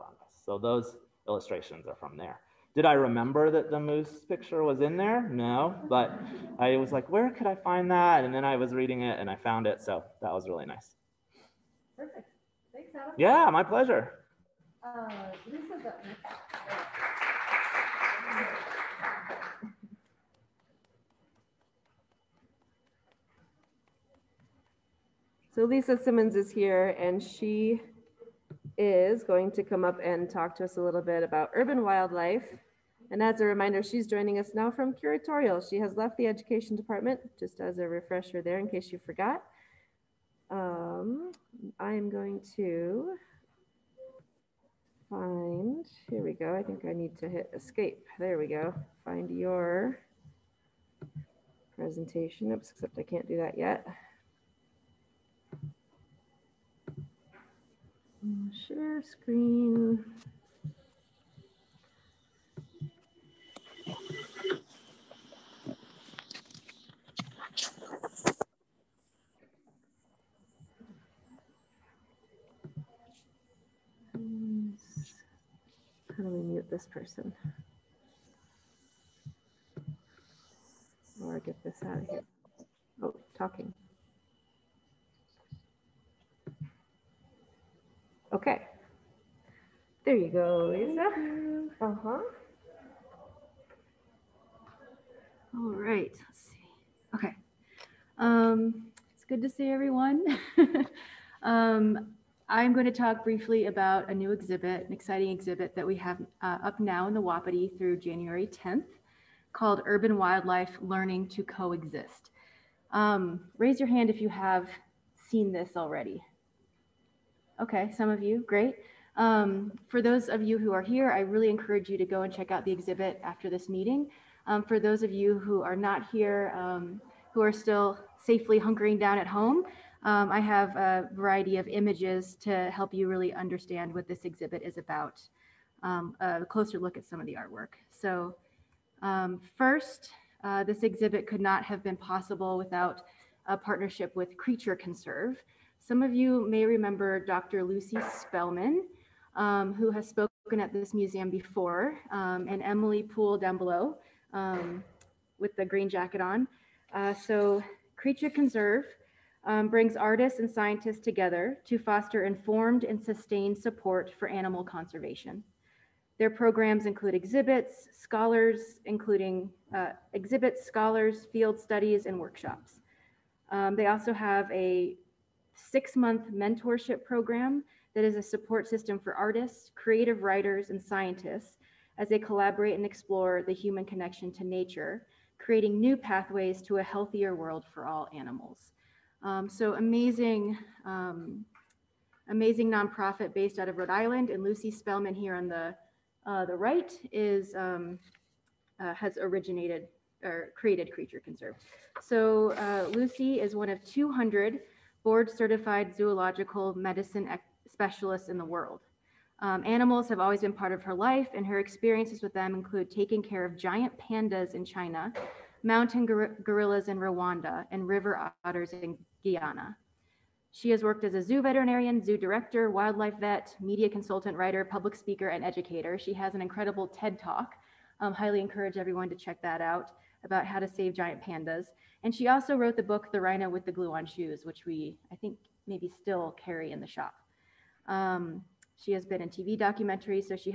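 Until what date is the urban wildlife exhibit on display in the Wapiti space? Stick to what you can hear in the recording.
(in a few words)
January 10th.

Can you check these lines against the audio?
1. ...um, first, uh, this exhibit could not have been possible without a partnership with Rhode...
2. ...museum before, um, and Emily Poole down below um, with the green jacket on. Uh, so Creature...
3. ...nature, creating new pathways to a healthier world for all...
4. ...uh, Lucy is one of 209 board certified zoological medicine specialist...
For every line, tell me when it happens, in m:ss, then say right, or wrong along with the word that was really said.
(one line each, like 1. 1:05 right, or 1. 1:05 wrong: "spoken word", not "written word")
1. 2:19 wrong: "Creature", not "Rhode"
2. 2:30 right
3. 3:04 right
4. 3:22 wrong: "200", not "209".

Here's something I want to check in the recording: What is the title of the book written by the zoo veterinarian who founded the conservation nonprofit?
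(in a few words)
The Rhino with the Glue on Shoes.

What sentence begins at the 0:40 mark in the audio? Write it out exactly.
Um, I am going to find, here we go.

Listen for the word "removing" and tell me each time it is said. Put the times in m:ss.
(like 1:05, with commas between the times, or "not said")
not said.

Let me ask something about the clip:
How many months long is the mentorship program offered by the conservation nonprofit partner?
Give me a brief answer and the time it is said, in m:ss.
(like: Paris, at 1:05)
6, at 2:55.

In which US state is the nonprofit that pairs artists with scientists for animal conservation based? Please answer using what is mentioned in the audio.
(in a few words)
Rhode Island.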